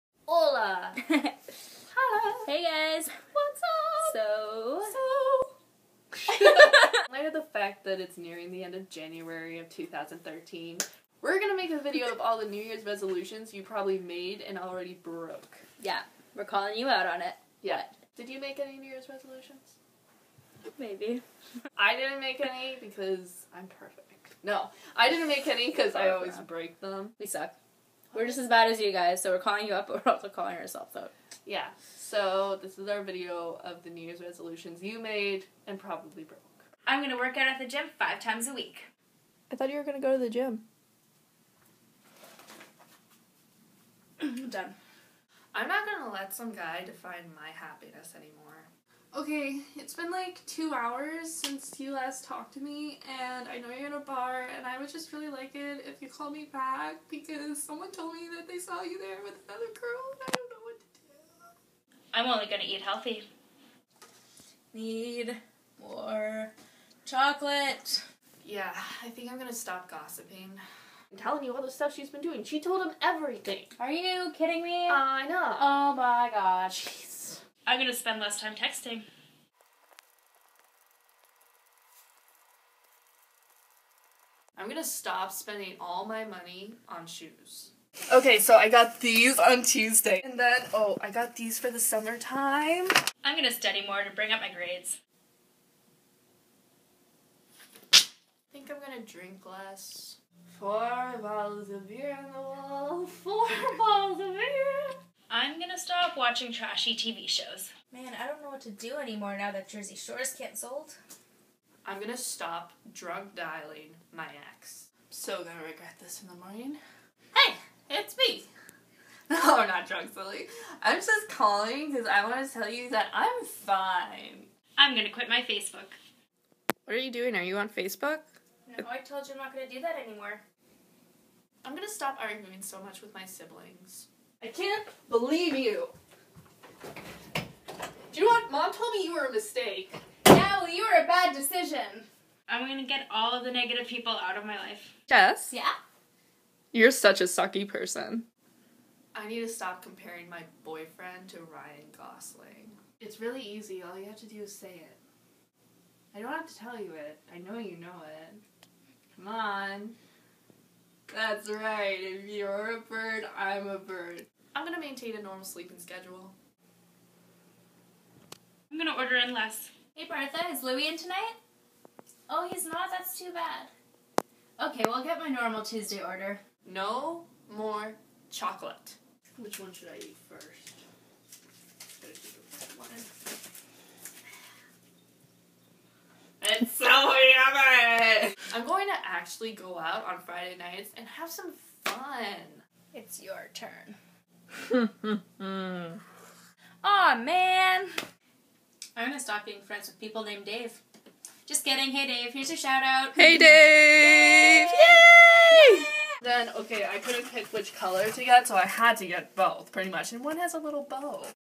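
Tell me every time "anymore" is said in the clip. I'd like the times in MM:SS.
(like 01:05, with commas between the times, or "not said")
00:48, 01:48, 02:10.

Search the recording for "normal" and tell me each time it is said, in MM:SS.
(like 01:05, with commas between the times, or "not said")
02:45, 02:55.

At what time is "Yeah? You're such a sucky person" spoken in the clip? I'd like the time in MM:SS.
02:25.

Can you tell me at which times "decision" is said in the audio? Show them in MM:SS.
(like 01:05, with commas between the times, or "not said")
02:21.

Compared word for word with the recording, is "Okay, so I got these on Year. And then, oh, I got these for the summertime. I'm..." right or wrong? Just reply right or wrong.
wrong.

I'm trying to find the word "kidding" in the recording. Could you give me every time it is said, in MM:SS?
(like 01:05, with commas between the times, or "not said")
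01:14, 03:21.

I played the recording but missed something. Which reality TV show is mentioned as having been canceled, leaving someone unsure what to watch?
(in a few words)
Jersey Shore.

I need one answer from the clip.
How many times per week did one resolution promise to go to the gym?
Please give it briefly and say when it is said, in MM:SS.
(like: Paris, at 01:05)
5, at 00:37.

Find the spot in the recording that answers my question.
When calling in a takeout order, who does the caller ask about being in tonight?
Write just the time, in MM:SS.
02:50.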